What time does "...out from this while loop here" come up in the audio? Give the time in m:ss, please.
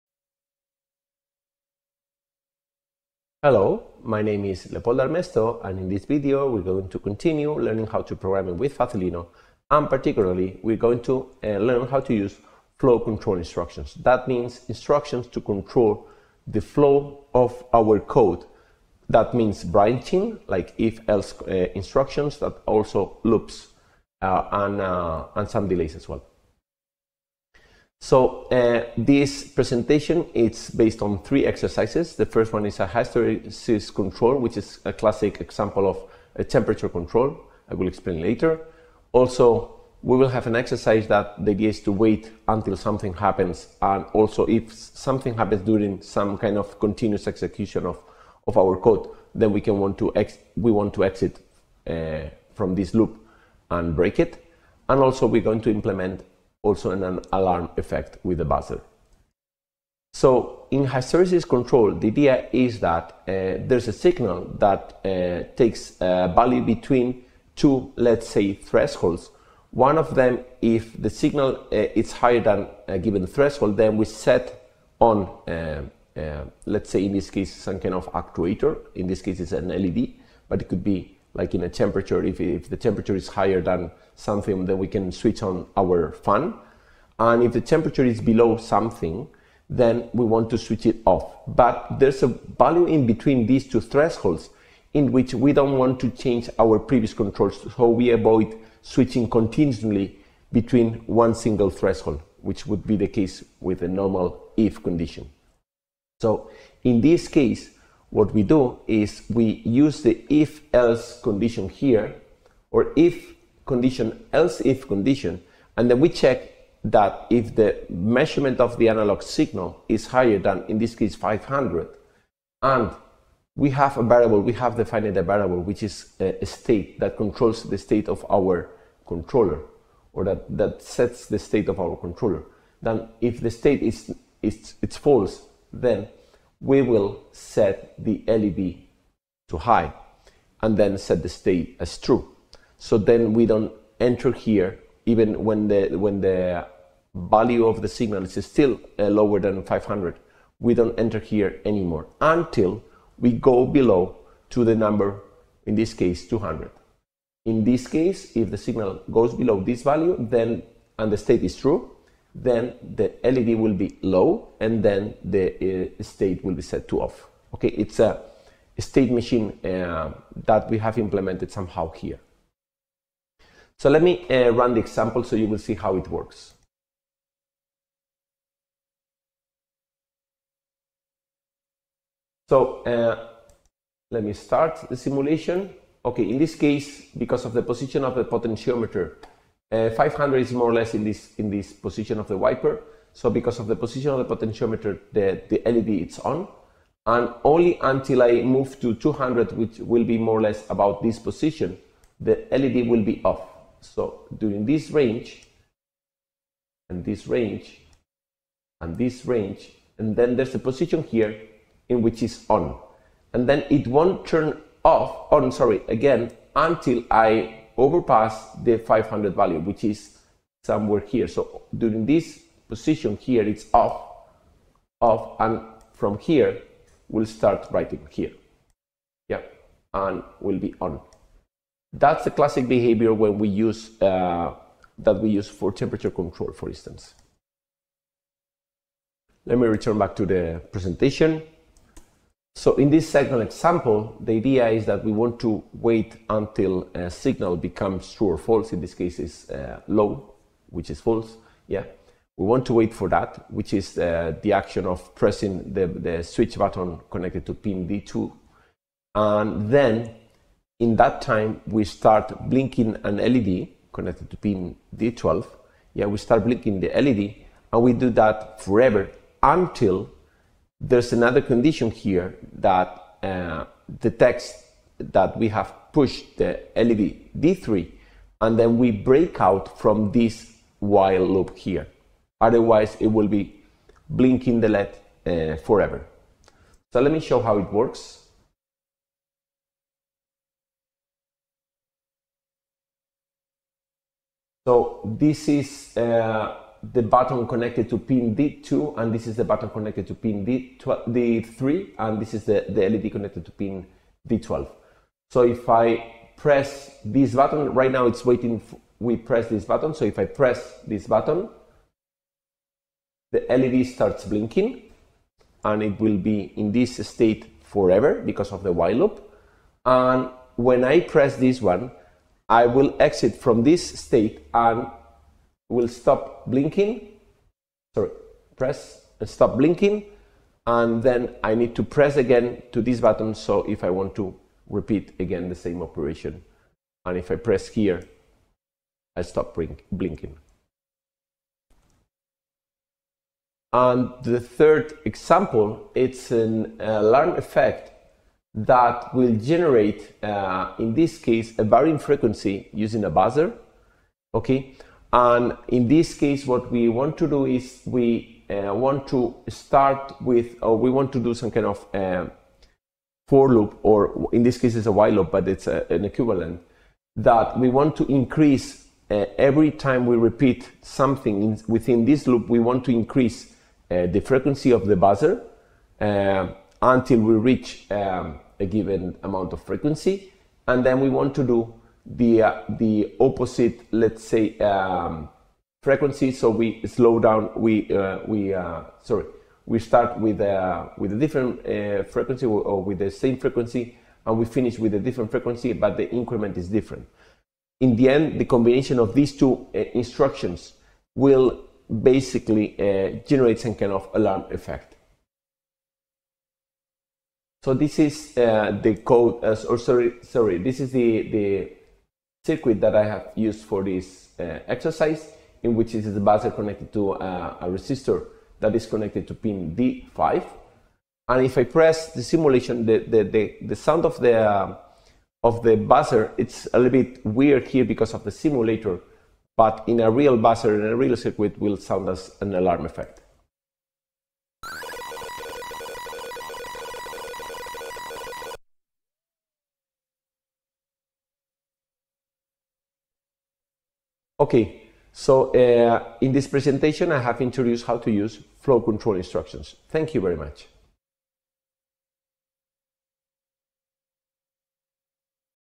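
4:39.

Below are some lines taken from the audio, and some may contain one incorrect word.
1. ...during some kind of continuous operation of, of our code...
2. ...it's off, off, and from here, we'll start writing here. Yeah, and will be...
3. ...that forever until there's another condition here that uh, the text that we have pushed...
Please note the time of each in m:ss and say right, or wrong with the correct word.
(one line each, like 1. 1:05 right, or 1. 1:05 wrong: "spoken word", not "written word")
1. 0:45 wrong: "execution", not "operation"
2. 3:43 right
3. 4:28 right.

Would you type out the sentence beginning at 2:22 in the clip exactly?
So then we don't enter here even when the, when the value of the signal is still uh, lower than 500.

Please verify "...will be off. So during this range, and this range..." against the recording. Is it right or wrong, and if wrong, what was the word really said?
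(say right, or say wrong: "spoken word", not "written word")
right.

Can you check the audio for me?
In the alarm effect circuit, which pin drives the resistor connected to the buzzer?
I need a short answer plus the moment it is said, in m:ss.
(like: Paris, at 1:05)
D5, at 6:59.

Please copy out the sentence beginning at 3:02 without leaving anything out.
So uh, let me start the simulation.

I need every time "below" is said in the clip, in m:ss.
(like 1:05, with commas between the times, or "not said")
1:28, 2:33, 2:39.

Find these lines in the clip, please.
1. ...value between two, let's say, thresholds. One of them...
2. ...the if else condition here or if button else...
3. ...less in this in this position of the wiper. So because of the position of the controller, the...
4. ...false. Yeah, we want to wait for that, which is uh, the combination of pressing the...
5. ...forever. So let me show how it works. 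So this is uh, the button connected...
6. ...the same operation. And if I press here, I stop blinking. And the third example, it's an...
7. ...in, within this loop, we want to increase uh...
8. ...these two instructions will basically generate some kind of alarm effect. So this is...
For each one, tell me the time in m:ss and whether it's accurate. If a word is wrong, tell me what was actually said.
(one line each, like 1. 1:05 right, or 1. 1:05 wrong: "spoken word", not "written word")
1. 1:06 right
2. 1:50 wrong: "condition", not "button"
3. 3:10 wrong: "potentiometer", not "controller"
4. 4:10 wrong: "action", not "combination"
5. 4:45 right
6. 5:35 right
7. 6:11 right
8. 6:39 right.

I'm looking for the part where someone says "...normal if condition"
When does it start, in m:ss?
1:43.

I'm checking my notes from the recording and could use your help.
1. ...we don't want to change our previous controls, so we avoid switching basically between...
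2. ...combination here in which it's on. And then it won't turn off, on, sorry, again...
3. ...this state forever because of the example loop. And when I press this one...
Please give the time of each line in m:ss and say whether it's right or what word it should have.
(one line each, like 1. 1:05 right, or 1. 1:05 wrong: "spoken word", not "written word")
1. 1:35 wrong: "continuously", not "basically"
2. 3:30 wrong: "position", not "combination"
3. 5:16 wrong: "while", not "example".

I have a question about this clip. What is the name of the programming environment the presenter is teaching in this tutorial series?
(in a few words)
Facilino.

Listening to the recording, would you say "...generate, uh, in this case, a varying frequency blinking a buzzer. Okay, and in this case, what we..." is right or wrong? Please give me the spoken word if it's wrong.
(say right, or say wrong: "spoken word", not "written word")
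wrong: "using", not "blinking".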